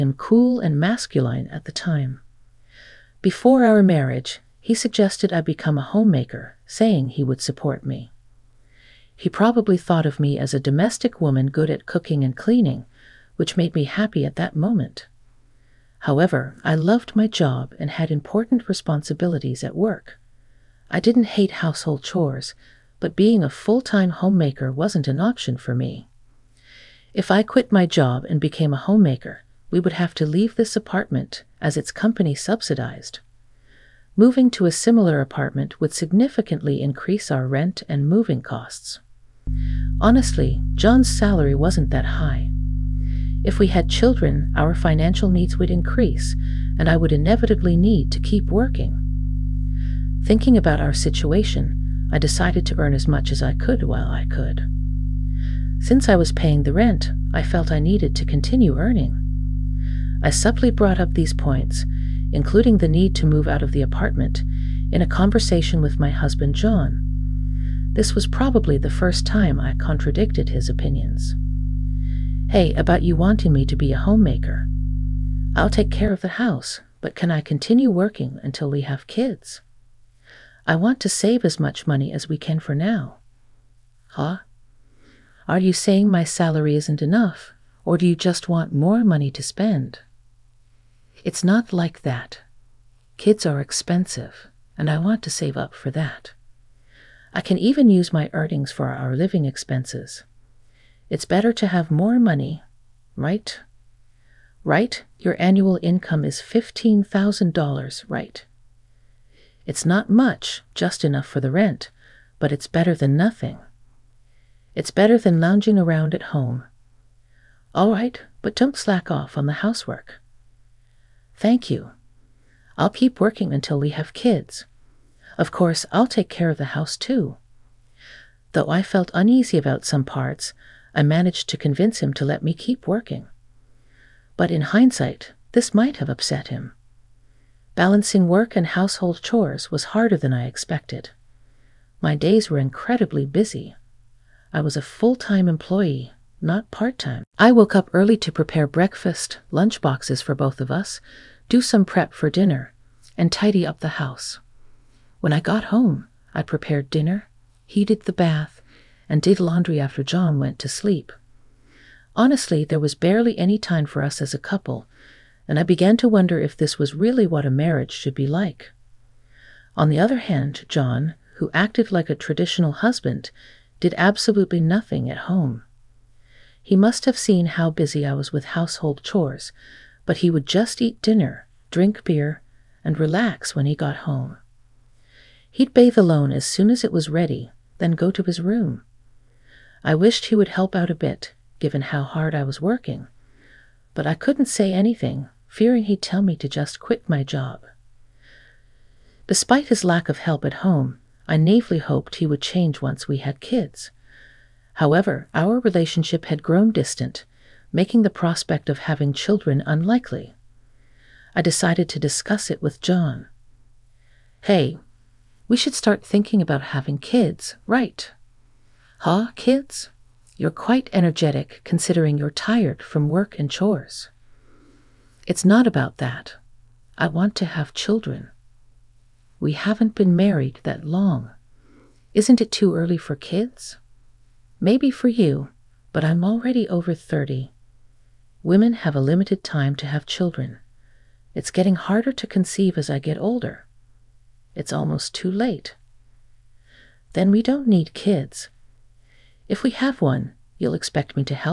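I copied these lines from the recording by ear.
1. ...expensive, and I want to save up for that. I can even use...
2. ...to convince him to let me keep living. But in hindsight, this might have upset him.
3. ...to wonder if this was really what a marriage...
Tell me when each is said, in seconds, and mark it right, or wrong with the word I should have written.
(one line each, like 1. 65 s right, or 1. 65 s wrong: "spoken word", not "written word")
1. 93 s right
2. 131 s wrong: "working", not "living"
3. 165 s right.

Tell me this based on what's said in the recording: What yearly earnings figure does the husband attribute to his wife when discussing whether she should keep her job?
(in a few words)
$15,000.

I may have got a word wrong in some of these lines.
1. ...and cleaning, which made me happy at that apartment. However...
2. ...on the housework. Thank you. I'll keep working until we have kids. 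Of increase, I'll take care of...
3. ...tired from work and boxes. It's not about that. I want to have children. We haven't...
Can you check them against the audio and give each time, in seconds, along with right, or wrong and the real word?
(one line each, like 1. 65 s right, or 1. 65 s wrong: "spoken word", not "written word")
1. 12 s wrong: "moment", not "apartment"
2. 119 s wrong: "course", not "increase"
3. 222 s wrong: "chores", not "boxes".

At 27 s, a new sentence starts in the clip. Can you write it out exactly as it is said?
If I quit my job and became a homemaker, we would have to leave this apartment as its company subsidized.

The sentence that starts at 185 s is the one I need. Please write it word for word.
He'd bathe alone as soon as it was ready, then go to his room.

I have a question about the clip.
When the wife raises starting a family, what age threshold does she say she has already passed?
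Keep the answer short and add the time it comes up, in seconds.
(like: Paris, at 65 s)
30, at 236 s.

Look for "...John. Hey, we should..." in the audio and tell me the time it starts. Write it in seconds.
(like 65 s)
212 s.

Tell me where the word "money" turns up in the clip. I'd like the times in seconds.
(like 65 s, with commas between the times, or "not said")
81 s, 89 s, 102 s.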